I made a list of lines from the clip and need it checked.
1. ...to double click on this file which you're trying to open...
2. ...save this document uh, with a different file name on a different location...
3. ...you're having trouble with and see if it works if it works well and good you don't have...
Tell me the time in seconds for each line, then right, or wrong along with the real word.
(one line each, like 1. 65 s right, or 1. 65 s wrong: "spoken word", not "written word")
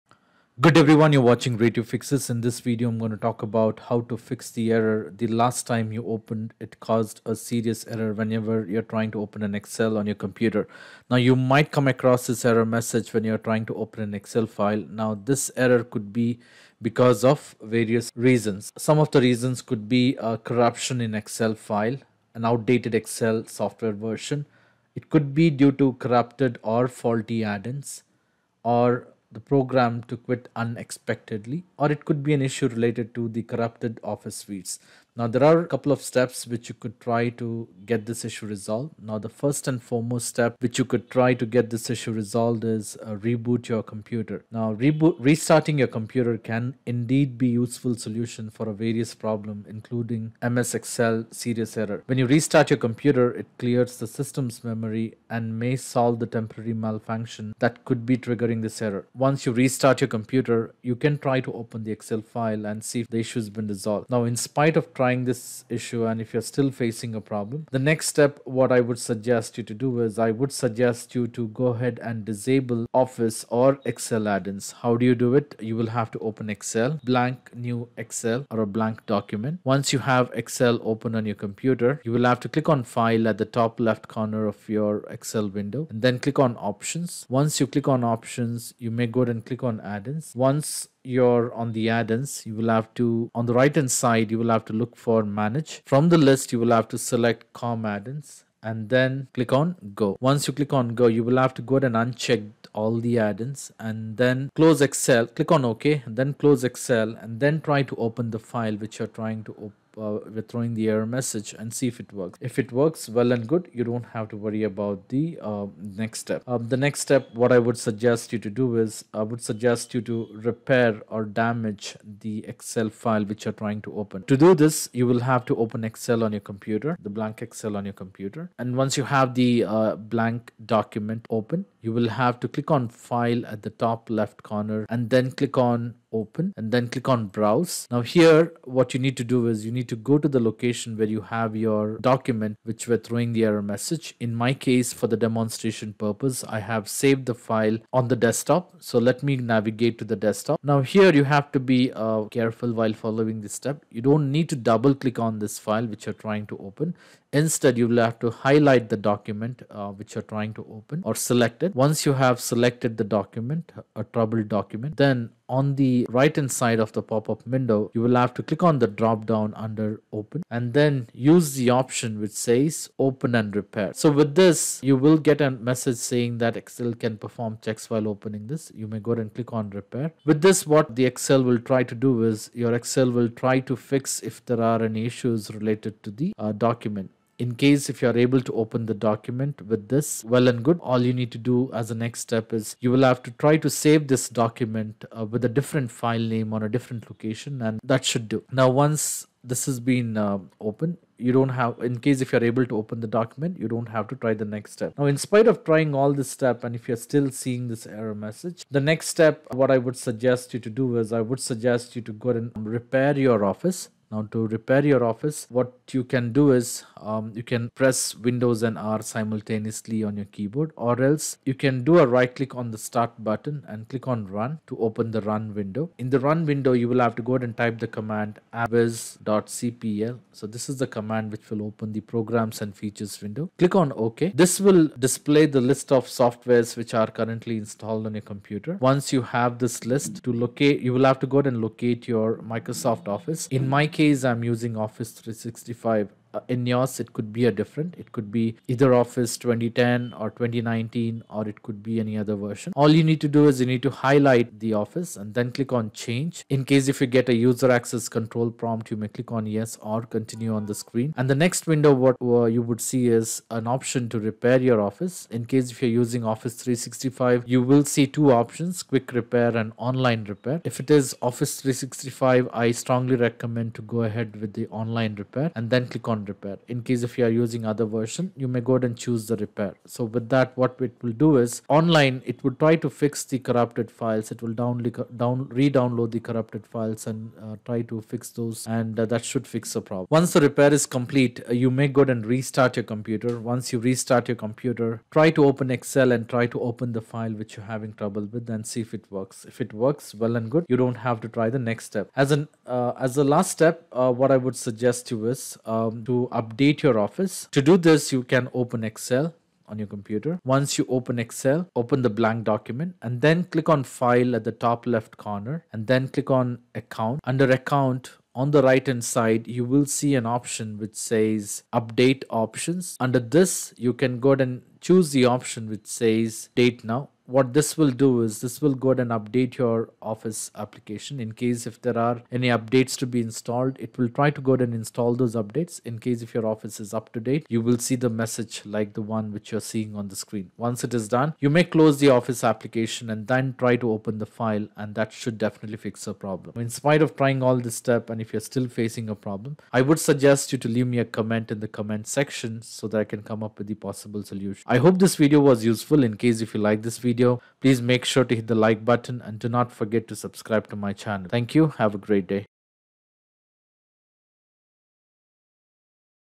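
1. 154 s right
2. 193 s right
3. 297 s right.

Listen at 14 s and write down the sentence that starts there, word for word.
Now, this error could be because of various reasons.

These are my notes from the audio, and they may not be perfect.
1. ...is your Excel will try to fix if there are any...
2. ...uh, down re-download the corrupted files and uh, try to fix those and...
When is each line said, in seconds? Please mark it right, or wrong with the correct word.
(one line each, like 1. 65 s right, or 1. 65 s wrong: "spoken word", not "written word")
1. 182 s right
2. 284 s right.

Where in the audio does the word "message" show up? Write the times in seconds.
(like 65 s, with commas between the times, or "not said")
12 s, 111 s, 143 s, 175 s, 208 s, 338 s.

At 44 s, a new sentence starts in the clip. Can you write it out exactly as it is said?
Now reboot restarting your computer can indeed be useful solution for a various problem including MS Excel serious error.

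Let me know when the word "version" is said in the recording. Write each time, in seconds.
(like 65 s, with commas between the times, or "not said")
23 s, 252 s, 277 s.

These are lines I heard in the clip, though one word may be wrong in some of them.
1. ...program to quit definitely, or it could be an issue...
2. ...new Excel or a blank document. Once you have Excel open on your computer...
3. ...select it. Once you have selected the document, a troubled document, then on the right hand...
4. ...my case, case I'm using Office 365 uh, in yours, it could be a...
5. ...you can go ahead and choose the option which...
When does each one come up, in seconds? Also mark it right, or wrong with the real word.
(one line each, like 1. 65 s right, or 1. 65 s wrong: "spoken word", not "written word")
1. 29 s wrong: "unexpectedly", not "definitely"
2. 77 s right
3. 161 s right
4. 243 s right
5. 323 s right.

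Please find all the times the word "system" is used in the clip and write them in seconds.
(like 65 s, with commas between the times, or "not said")
54 s.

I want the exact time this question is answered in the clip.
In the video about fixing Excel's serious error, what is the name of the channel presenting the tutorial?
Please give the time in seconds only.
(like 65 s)
1 s.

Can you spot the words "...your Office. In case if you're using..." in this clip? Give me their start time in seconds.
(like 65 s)
264 s.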